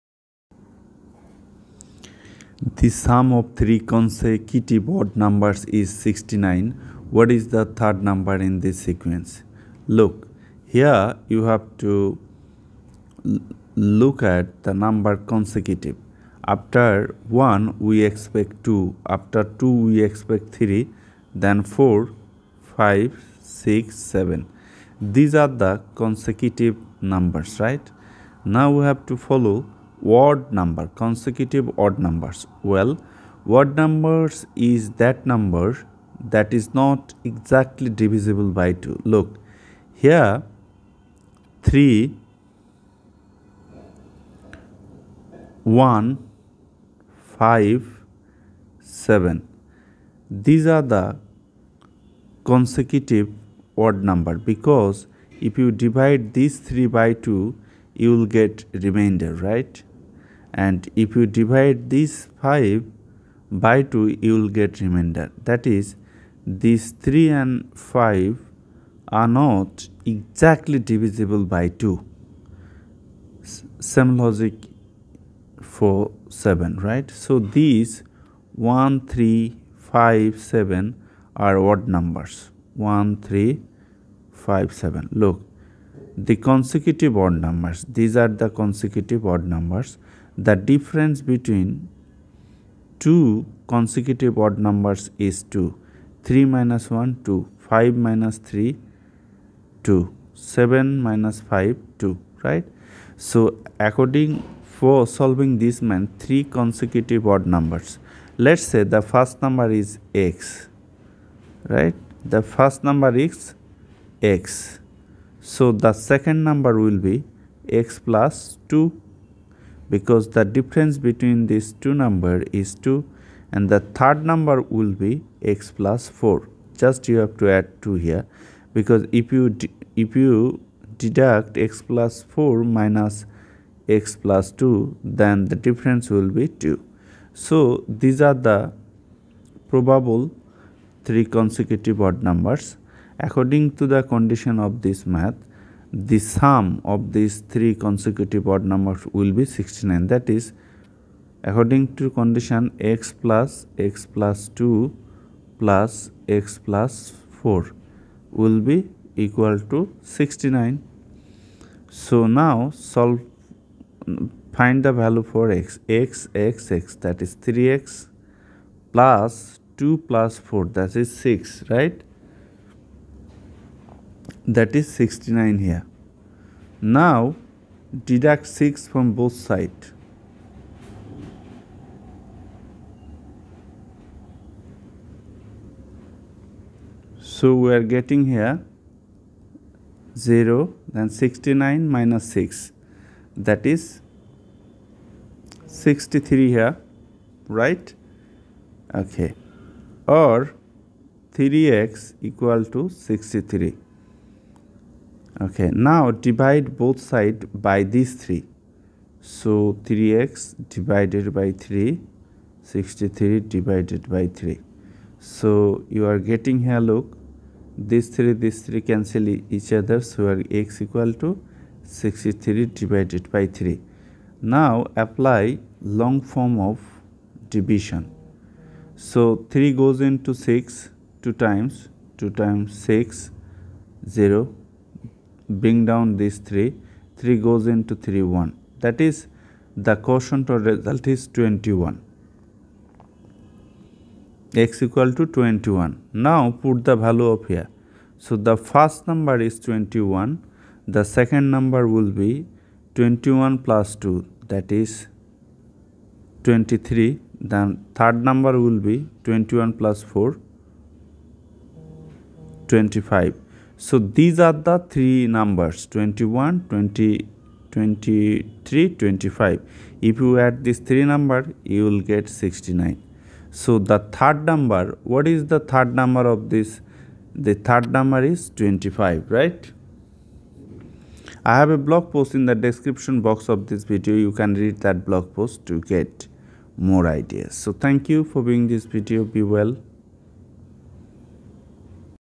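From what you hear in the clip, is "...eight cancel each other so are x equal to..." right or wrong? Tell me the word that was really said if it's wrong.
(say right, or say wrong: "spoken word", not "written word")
wrong: "three", not "eight".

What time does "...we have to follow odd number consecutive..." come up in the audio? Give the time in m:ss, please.
0:28.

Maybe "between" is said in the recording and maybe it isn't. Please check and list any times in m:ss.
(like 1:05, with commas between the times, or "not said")
1:31, 2:00.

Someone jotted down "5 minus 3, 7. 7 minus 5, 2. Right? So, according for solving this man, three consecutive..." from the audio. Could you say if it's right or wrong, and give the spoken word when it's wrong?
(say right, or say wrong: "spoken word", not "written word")
wrong: "2", not "7".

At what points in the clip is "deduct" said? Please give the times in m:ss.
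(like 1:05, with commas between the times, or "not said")
2:11, 2:58.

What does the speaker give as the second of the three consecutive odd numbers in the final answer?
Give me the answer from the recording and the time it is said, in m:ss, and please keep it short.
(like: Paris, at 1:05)
23, at 4:12.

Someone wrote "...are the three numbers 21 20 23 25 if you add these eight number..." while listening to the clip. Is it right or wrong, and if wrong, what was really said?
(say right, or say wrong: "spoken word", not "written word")
wrong: "three", not "eight".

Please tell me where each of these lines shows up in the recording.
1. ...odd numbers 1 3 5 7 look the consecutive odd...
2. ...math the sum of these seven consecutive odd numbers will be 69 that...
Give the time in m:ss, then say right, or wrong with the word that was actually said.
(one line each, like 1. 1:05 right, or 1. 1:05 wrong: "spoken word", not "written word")
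1. 1:21 right
2. 2:25 wrong: "three", not "seven".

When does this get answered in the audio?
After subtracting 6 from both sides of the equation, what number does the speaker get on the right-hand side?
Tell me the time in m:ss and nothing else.
3:11.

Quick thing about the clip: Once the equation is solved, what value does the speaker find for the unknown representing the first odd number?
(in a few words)
21.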